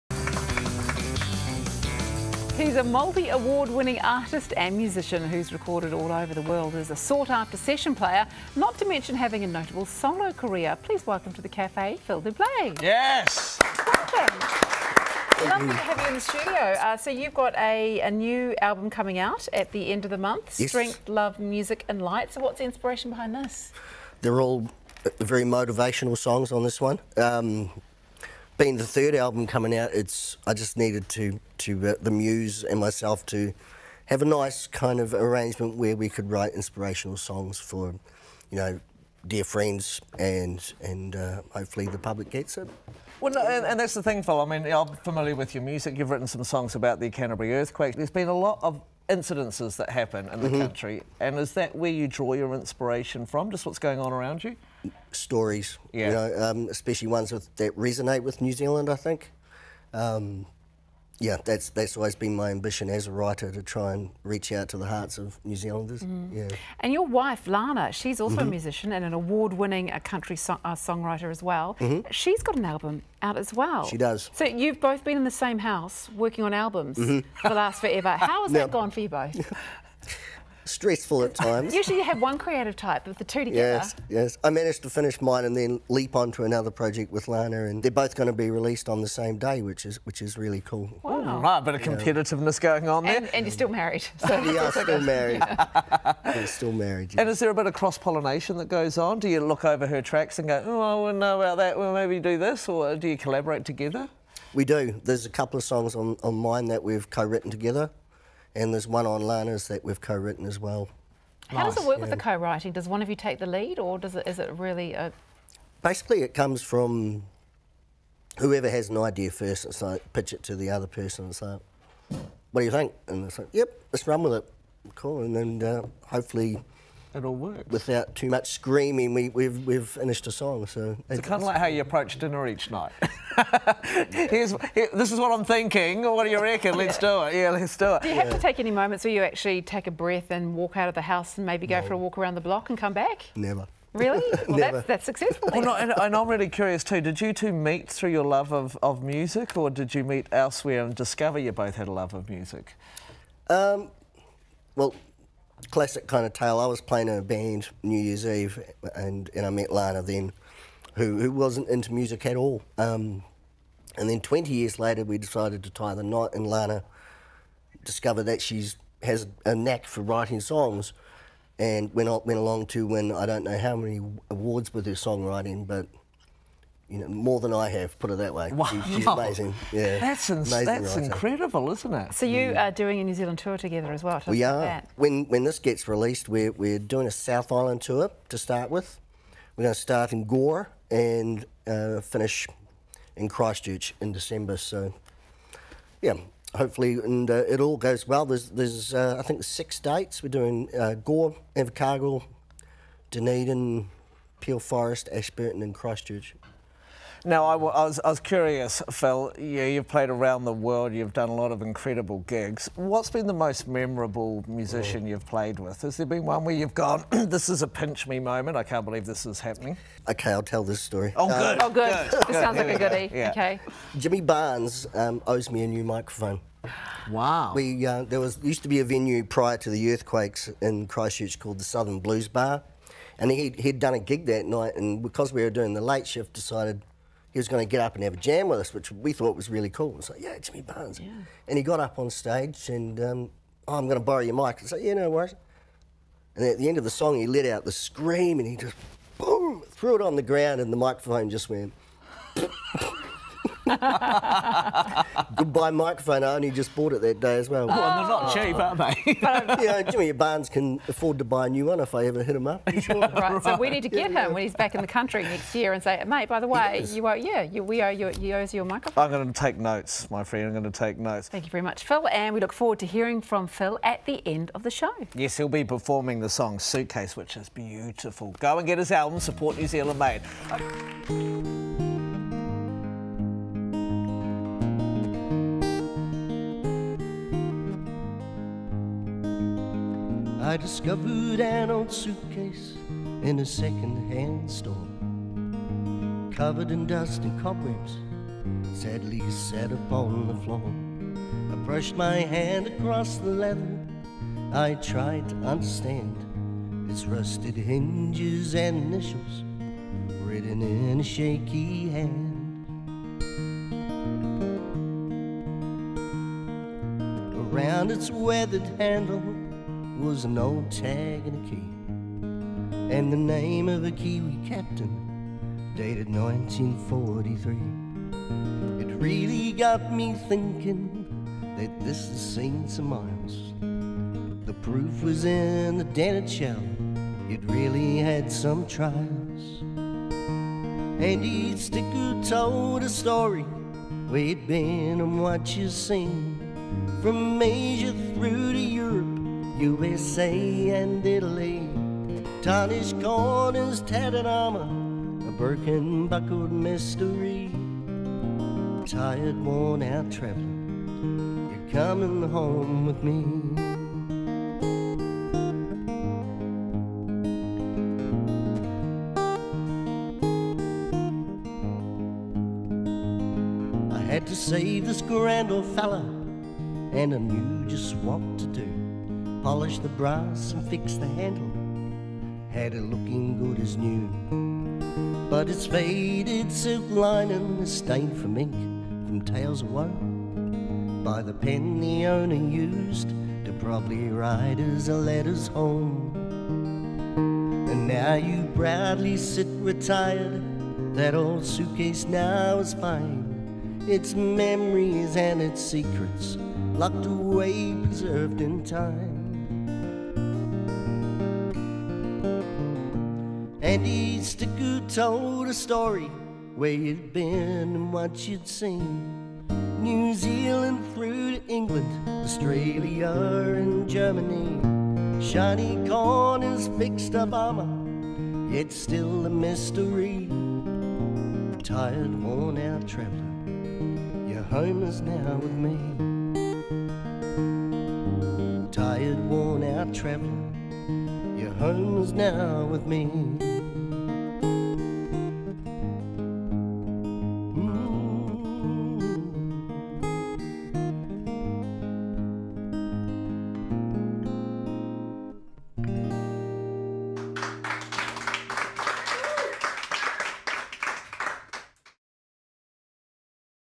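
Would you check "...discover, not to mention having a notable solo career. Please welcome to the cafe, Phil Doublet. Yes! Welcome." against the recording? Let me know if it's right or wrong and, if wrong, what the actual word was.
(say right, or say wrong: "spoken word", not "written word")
wrong: "player", not "discover".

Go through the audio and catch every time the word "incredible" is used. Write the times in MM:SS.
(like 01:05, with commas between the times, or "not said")
03:00, 03:31.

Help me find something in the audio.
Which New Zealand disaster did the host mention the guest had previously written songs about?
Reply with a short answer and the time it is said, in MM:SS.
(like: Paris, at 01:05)
Canterbury earthquake, at 00:47.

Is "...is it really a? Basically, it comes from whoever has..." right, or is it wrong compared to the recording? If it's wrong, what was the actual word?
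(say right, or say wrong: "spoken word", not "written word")
right.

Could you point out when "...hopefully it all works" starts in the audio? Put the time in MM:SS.
02:06.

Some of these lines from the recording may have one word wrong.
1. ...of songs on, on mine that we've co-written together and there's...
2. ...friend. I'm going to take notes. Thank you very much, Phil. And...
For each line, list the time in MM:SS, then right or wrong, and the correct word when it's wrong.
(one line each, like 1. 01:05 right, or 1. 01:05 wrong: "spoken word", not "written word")
1. 01:45 right
2. 04:30 right.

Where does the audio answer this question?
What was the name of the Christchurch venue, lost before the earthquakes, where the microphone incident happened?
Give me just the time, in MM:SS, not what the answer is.
03:51.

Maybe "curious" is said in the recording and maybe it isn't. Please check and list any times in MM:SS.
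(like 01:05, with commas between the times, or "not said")
02:26, 03:28.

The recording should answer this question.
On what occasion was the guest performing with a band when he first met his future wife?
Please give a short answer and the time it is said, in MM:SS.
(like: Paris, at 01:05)
New Year's Eve, at 02:37.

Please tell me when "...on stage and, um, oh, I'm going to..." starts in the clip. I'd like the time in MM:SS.
04:01.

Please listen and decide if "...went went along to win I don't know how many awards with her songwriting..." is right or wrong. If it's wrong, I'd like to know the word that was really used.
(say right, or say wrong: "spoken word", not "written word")
right.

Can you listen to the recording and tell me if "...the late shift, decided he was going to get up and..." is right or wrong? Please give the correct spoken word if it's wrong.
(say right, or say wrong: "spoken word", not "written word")
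right.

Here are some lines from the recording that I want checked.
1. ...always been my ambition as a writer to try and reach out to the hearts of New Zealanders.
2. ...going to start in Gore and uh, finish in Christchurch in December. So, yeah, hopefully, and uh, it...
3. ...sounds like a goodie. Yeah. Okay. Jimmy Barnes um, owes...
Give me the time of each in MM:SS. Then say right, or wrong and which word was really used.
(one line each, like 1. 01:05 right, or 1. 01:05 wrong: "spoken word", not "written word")
1. 01:01 right
2. 03:09 right
3. 03:42 right.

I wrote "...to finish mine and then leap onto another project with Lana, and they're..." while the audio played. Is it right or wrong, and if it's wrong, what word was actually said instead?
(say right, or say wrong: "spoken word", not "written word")
right.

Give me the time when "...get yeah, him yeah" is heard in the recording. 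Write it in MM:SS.
04:23.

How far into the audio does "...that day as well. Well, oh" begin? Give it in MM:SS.
04:17.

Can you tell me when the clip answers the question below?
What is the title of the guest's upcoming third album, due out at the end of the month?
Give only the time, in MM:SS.
00:20.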